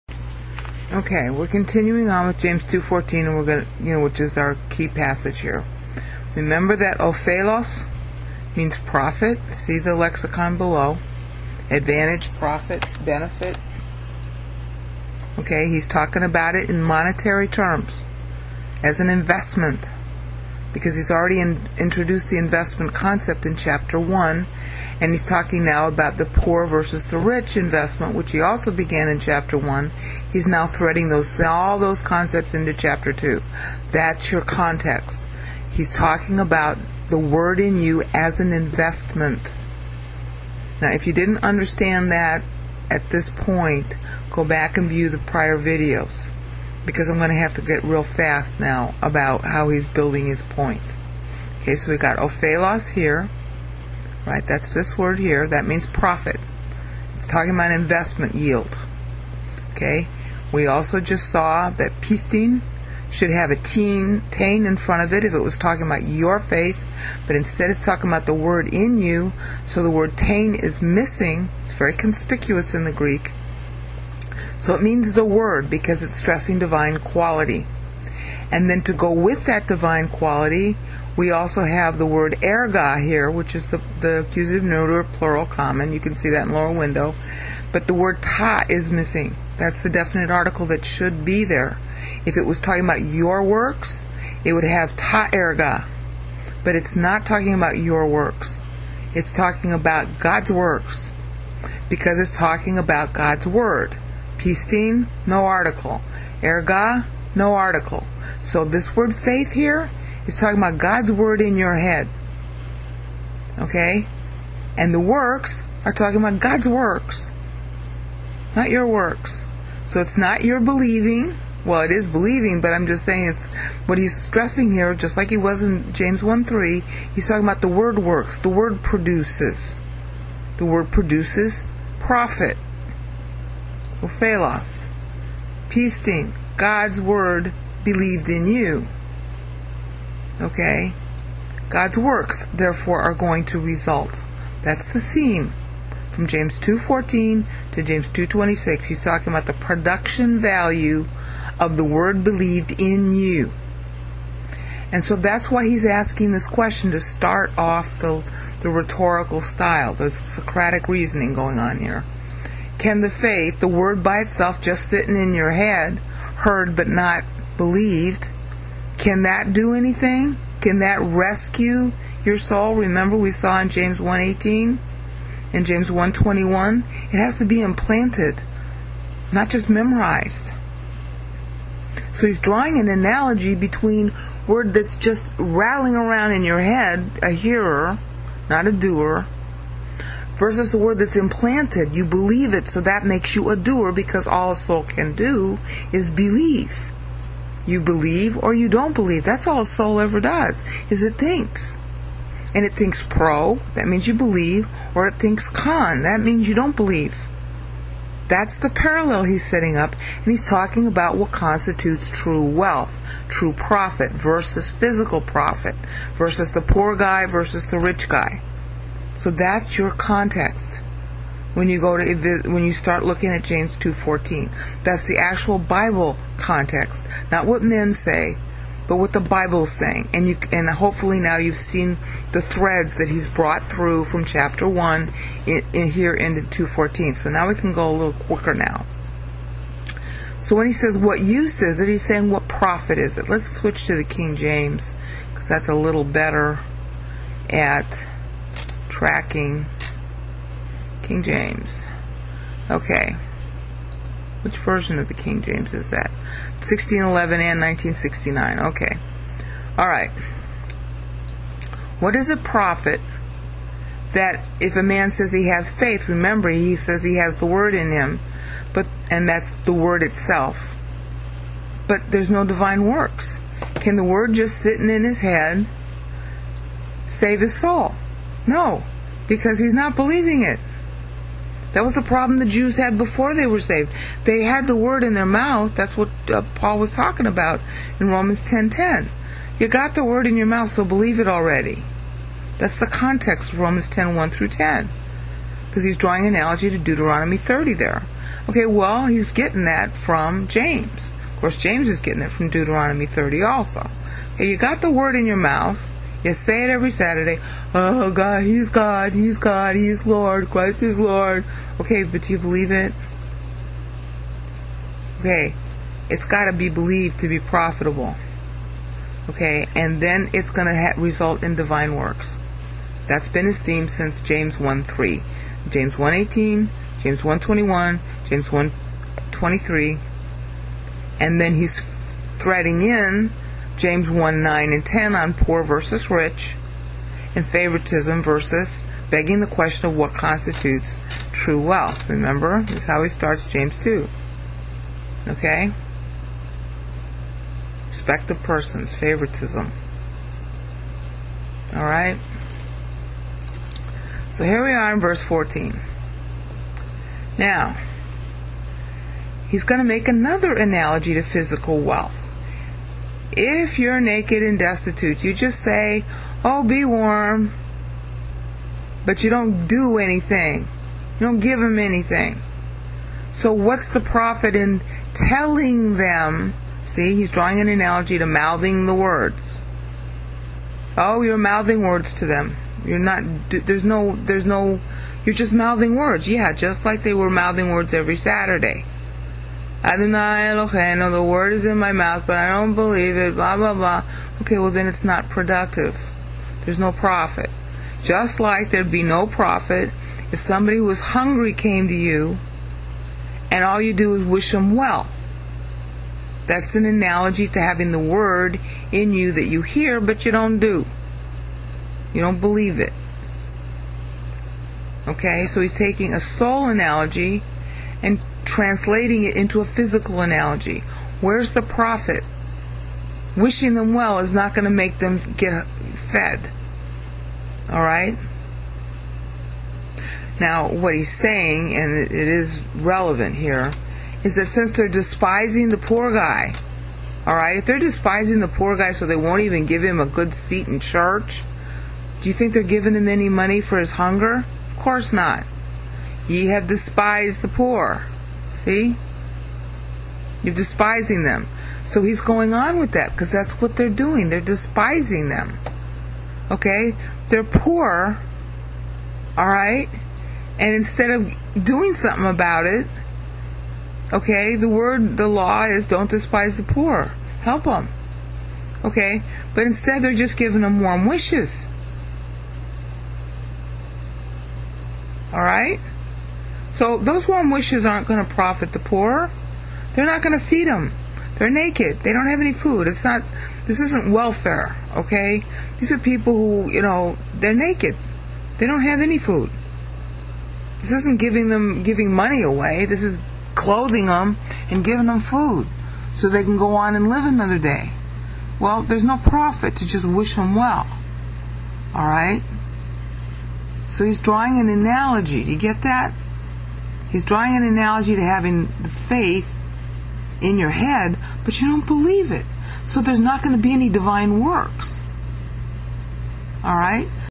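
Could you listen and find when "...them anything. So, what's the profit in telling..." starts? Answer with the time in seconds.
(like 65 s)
371 s.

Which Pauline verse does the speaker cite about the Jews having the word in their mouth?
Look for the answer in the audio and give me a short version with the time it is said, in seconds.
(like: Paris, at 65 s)
Romans 10:10, at 288 s.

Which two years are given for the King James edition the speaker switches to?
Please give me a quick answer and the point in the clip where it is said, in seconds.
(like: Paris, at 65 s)
1611 and 1969, at 256 s.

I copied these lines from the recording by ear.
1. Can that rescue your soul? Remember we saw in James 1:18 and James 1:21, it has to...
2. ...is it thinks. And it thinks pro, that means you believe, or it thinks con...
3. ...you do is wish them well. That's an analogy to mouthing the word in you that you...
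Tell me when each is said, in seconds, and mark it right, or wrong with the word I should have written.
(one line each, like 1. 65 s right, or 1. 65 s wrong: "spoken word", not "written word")
1. 170 s right
2. 200 s right
3. 403 s wrong: "having", not "mouthing".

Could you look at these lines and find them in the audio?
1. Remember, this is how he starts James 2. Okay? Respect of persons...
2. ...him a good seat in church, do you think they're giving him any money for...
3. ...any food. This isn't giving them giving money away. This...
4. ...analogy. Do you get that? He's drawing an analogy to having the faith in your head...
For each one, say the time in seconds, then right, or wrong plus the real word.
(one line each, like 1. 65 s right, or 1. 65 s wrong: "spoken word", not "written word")
1. 342 s right
2. 439 s right
3. 489 s right
4. 504 s right.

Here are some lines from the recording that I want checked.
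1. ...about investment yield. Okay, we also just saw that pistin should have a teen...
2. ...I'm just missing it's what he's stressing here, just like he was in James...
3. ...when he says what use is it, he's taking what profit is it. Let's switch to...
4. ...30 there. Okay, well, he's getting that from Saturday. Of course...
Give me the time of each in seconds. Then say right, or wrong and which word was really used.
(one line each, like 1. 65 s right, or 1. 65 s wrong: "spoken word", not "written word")
1. 57 s right
2. 122 s wrong: "saying", not "missing"
3. 240 s wrong: "saying", not "taking"
4. 297 s wrong: "James", not "Saturday".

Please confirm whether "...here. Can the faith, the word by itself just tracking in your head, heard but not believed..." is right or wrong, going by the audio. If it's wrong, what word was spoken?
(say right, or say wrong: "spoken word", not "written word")
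wrong: "sitting", not "tracking".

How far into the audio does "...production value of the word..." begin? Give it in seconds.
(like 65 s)
149 s.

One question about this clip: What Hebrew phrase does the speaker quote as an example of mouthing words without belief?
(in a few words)
Adonai Eloheinu.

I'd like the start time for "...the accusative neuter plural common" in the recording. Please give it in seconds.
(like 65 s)
84 s.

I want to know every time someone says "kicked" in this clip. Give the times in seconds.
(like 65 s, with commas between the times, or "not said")
not said.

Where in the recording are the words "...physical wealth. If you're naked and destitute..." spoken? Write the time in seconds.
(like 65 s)
361 s.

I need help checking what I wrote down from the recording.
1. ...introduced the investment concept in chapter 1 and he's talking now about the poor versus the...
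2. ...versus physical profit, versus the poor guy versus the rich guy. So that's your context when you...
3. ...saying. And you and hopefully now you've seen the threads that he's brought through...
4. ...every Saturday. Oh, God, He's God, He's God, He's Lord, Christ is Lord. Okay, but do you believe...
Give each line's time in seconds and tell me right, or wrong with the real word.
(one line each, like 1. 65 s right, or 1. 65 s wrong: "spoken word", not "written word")
1. 21 s right
2. 214 s right
3. 229 s right
4. 306 s right.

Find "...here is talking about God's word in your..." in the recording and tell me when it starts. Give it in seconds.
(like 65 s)
109 s.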